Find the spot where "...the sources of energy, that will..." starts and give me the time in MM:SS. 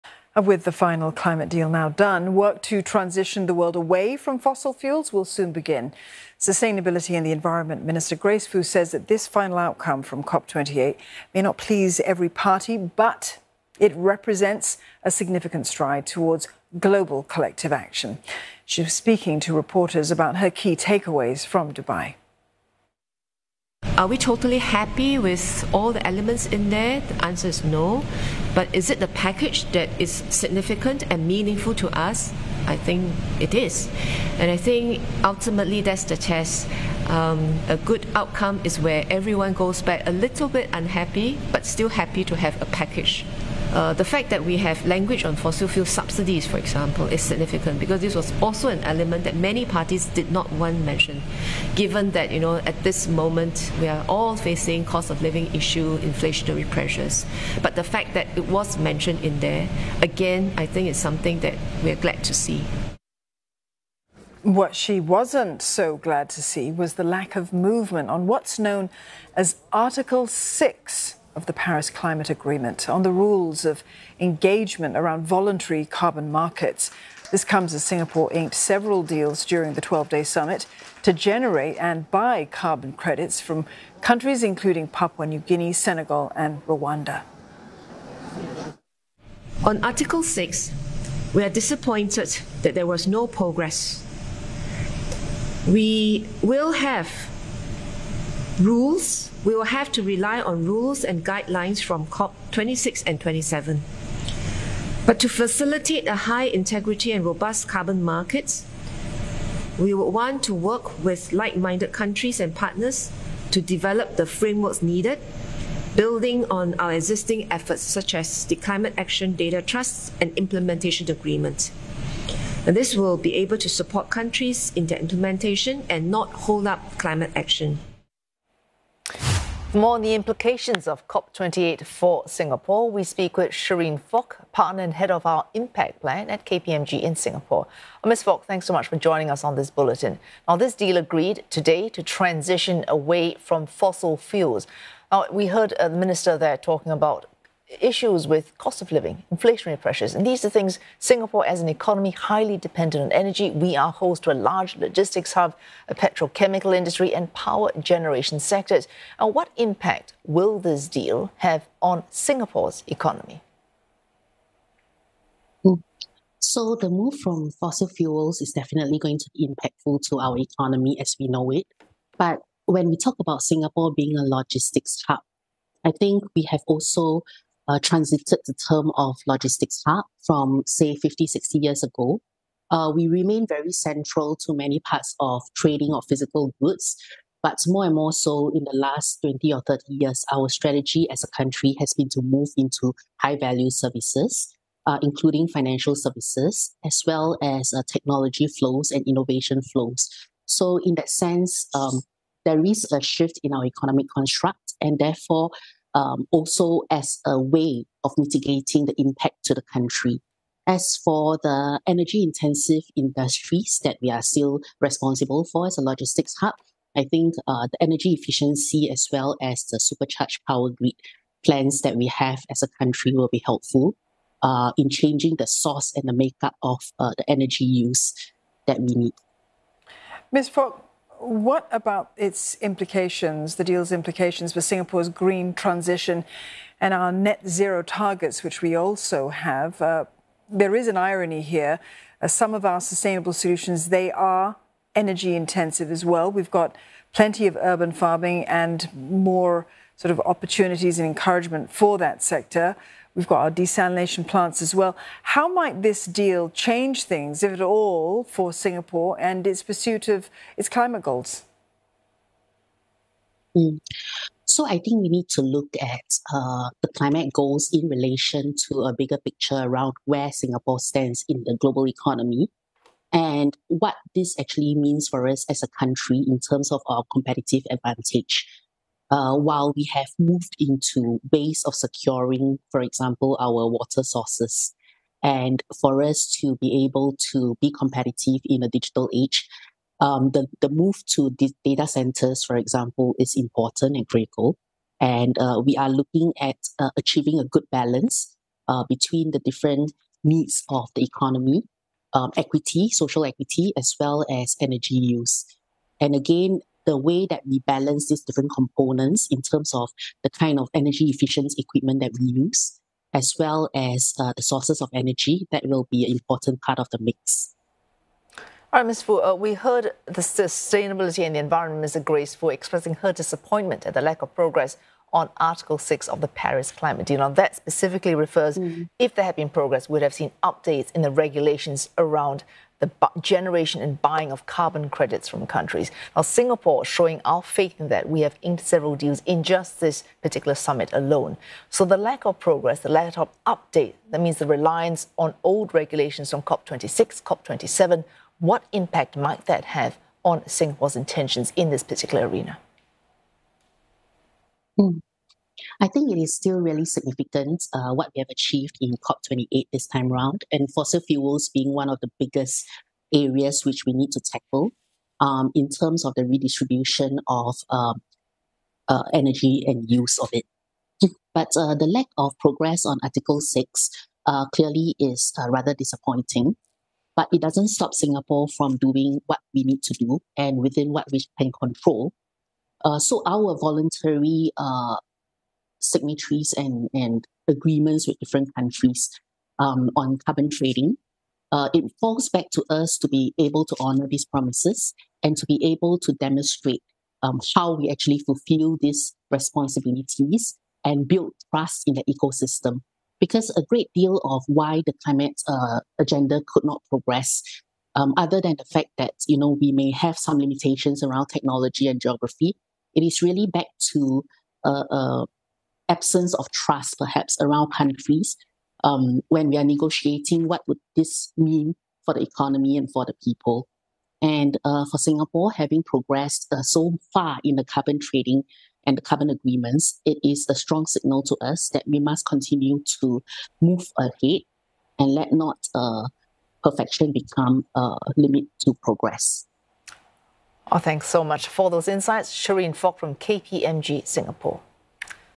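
05:14.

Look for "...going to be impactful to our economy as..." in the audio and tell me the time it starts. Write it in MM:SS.
02:48.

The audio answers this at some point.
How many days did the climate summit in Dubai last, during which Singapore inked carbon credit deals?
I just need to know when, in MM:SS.
01:19.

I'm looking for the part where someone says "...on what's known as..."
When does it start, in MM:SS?
01:08.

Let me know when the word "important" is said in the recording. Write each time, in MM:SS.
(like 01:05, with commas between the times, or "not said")
04:53, 05:16.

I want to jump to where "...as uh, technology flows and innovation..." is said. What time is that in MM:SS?
03:17.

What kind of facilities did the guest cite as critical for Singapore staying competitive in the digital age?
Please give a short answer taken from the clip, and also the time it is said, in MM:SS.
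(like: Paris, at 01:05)
data centers, at 04:51.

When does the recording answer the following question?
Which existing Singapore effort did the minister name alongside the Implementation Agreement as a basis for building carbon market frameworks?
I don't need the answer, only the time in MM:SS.
01:58.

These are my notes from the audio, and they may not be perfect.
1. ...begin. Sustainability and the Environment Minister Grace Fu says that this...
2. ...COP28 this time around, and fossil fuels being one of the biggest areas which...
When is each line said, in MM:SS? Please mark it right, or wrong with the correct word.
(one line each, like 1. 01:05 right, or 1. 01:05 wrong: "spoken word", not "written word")
1. 00:05 right
2. 05:59 right.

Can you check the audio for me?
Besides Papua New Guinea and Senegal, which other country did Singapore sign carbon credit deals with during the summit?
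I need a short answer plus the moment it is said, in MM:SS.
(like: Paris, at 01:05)
Rwanda, at 01:26.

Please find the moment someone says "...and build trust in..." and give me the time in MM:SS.
06:40.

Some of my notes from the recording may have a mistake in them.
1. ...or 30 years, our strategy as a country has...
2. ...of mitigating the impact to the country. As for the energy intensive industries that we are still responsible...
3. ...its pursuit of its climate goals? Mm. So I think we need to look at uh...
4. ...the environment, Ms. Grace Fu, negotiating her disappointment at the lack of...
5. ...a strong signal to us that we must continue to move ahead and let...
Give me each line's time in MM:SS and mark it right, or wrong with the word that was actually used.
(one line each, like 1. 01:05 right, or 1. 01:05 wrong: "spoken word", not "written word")
1. 03:09 right
2. 03:28 right
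3. 04:19 right
4. 05:21 wrong: "expressing", not "negotiating"
5. 07:10 right.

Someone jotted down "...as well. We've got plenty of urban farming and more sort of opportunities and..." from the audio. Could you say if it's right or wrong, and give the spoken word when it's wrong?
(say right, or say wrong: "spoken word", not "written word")
right.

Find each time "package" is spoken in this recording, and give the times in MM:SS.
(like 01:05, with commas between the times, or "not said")
00:29, 00:42.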